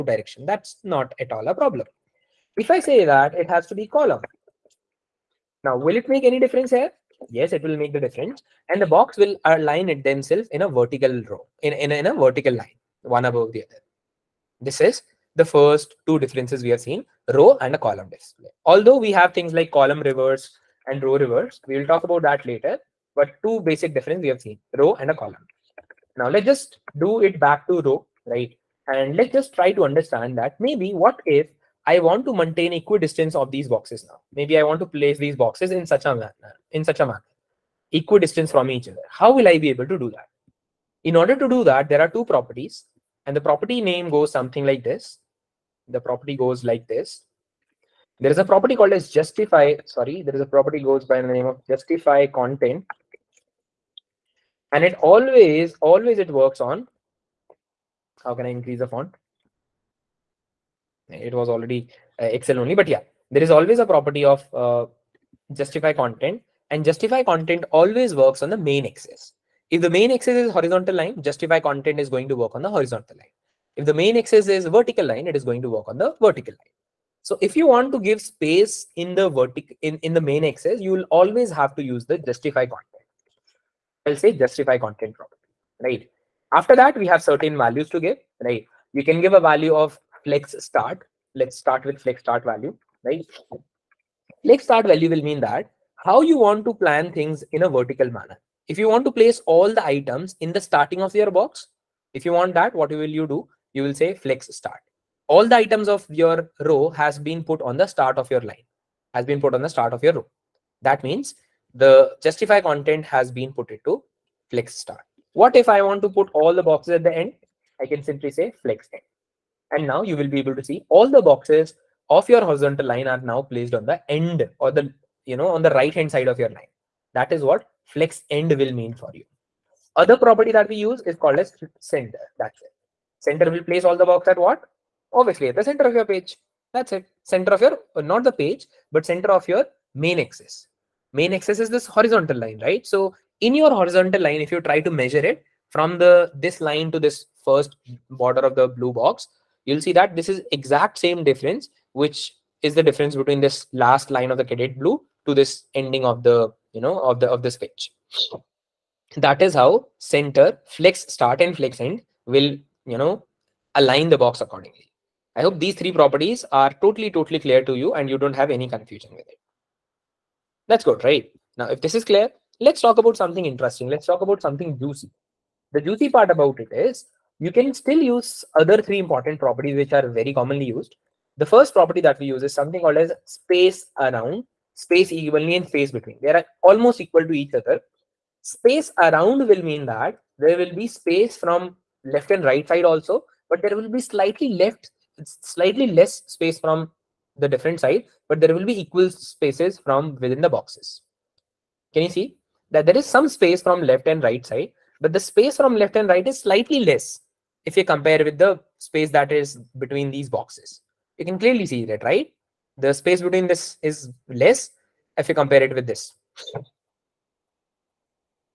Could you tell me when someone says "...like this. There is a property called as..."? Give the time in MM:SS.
00:46.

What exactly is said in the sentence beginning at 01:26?
After that, we have certain values to give, right?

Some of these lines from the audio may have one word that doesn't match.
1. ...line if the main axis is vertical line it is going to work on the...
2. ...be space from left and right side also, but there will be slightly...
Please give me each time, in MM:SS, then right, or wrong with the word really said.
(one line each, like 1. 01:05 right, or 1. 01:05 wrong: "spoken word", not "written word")
1. 01:13 right
2. 03:10 right.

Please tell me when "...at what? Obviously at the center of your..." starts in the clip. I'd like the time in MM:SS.
02:14.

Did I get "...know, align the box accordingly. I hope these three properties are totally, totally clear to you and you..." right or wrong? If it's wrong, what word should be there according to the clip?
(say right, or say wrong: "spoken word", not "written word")
right.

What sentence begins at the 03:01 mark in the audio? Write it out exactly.
The first property that we use is something called as space around, space evenly and space between.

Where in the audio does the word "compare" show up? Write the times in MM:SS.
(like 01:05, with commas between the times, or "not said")
03:27, 03:35.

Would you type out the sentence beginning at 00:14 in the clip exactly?
This is the first two differences we have seen, row and a column display.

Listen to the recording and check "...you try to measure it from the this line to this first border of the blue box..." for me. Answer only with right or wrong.
right.